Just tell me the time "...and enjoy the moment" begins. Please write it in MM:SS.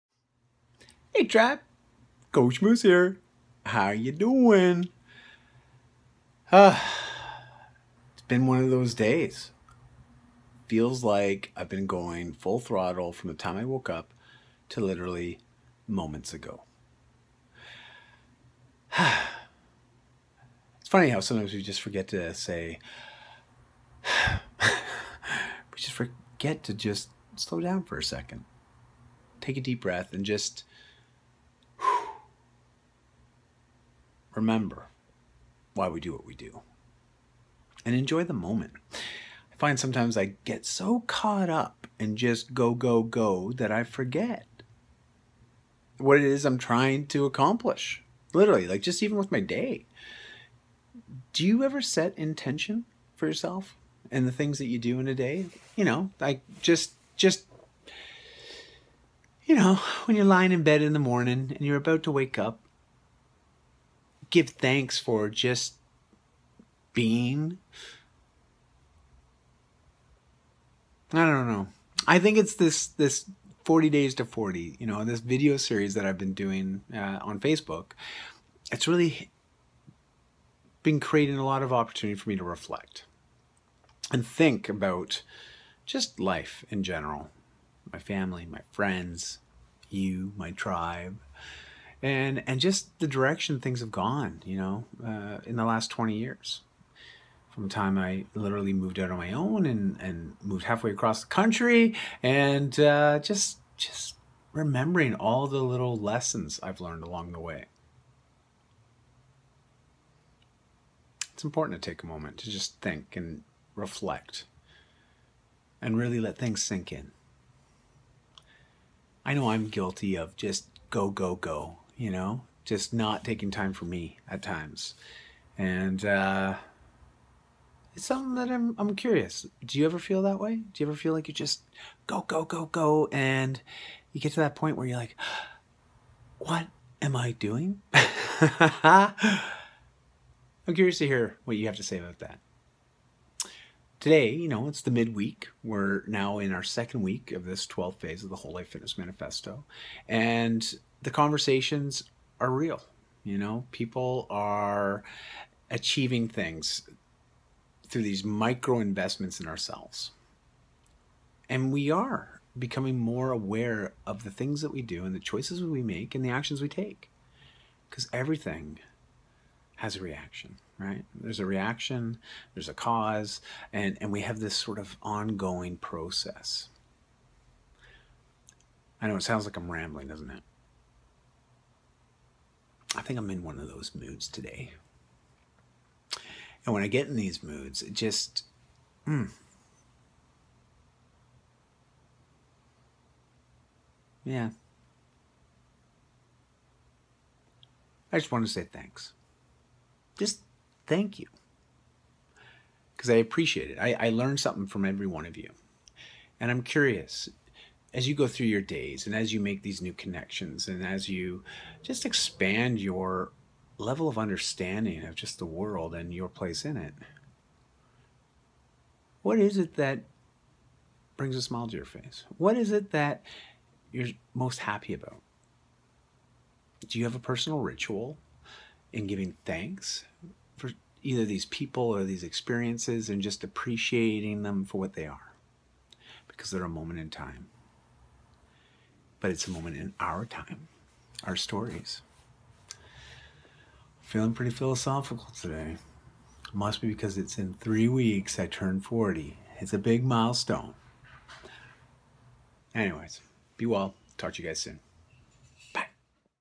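00:37.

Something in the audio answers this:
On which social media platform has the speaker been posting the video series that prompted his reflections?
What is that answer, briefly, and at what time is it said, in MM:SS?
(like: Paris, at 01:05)
Facebook, at 01:17.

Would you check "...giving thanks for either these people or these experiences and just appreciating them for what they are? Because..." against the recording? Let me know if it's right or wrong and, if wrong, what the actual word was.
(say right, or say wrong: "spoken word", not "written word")
right.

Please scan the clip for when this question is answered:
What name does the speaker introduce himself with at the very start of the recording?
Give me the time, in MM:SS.
00:02.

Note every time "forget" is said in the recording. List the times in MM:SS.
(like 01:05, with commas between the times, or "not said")
00:21, 00:25, 00:43.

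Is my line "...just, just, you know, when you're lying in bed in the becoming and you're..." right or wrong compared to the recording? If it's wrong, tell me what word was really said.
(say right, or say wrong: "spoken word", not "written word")
wrong: "morning", not "becoming".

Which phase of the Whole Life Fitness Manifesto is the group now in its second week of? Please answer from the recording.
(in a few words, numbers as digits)
12th.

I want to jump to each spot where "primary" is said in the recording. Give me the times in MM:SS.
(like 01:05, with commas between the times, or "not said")
not said.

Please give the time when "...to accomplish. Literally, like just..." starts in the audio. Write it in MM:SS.
00:47.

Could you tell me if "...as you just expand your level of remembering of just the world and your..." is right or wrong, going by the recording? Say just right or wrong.
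wrong.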